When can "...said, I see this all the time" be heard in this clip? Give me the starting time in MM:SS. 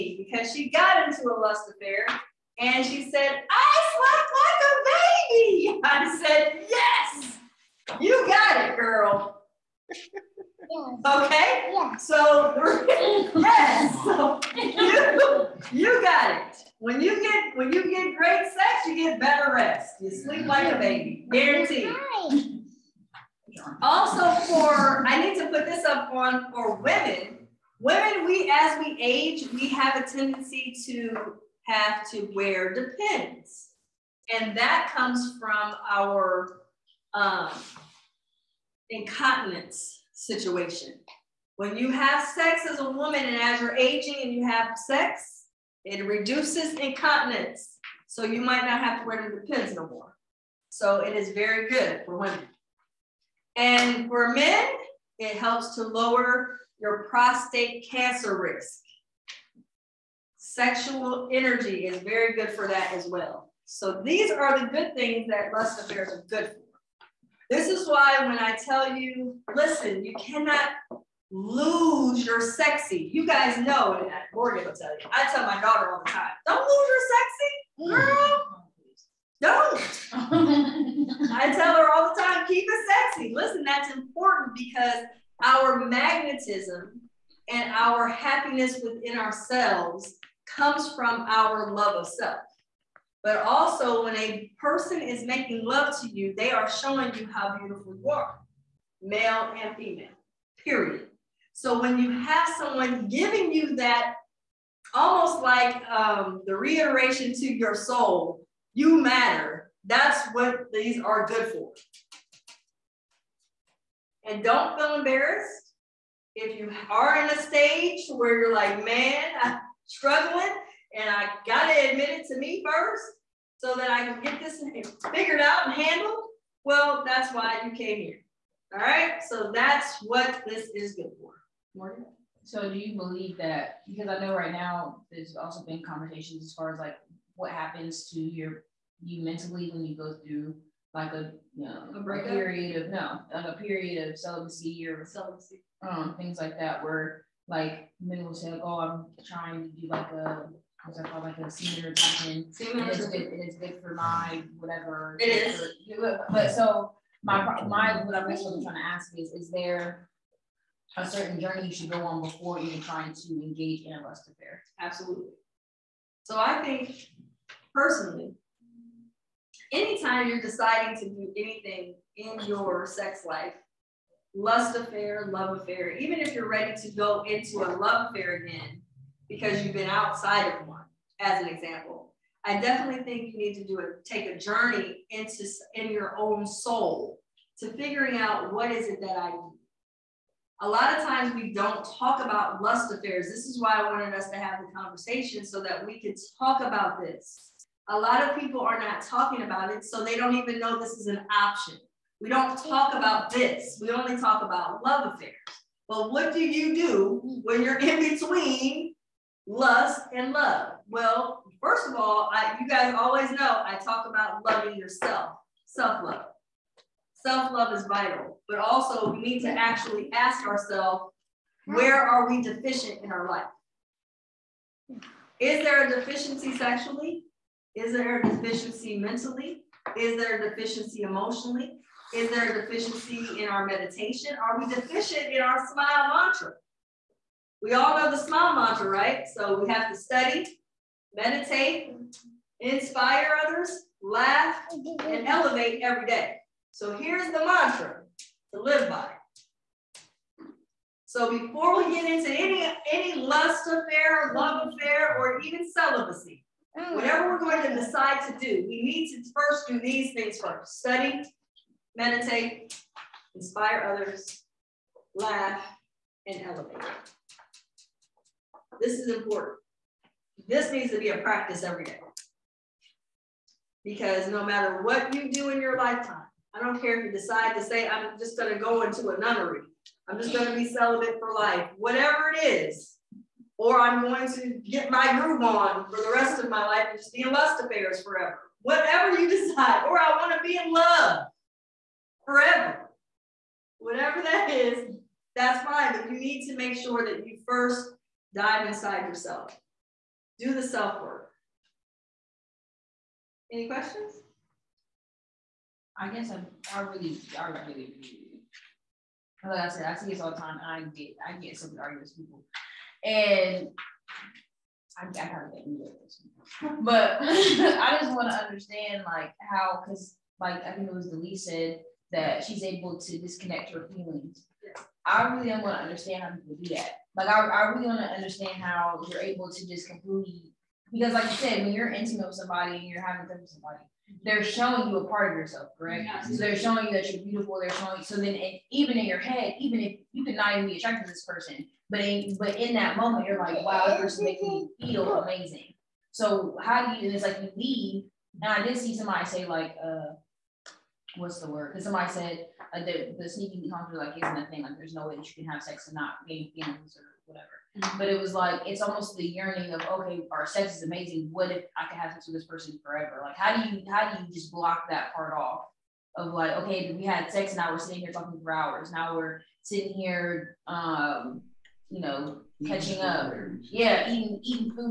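05:09.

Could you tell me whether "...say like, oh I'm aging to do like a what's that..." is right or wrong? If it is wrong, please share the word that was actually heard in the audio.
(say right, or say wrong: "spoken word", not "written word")
wrong: "trying", not "aging".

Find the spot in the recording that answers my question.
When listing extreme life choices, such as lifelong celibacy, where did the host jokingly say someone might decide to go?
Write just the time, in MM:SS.
04:39.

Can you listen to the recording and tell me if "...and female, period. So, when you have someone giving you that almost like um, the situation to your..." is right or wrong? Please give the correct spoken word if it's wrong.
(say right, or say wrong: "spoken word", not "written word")
wrong: "reiteration", not "situation".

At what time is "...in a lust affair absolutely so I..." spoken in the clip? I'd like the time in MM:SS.
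02:43.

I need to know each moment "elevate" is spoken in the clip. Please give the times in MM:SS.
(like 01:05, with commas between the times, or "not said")
04:05, 04:26.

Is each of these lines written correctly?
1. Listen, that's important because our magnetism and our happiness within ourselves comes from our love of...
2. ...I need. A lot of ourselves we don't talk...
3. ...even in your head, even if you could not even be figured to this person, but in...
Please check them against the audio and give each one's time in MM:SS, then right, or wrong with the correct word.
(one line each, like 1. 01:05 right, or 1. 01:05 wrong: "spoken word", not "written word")
1. 01:23 right
2. 03:09 wrong: "times", not "ourselves"
3. 05:38 wrong: "attracted", not "figured".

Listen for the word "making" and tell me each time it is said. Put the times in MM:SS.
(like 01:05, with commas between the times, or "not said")
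01:35, 05:44.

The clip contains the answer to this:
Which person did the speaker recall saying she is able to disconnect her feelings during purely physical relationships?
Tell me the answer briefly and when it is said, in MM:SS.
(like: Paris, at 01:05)
Delise, at 05:21.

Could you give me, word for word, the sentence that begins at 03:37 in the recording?
Self-love is vital, but also we need to actually ask ourselves, where are we deficient in our life?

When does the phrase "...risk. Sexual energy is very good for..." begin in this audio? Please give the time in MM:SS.
00:58.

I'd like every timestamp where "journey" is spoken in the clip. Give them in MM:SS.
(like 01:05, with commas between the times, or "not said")
02:41, 03:04.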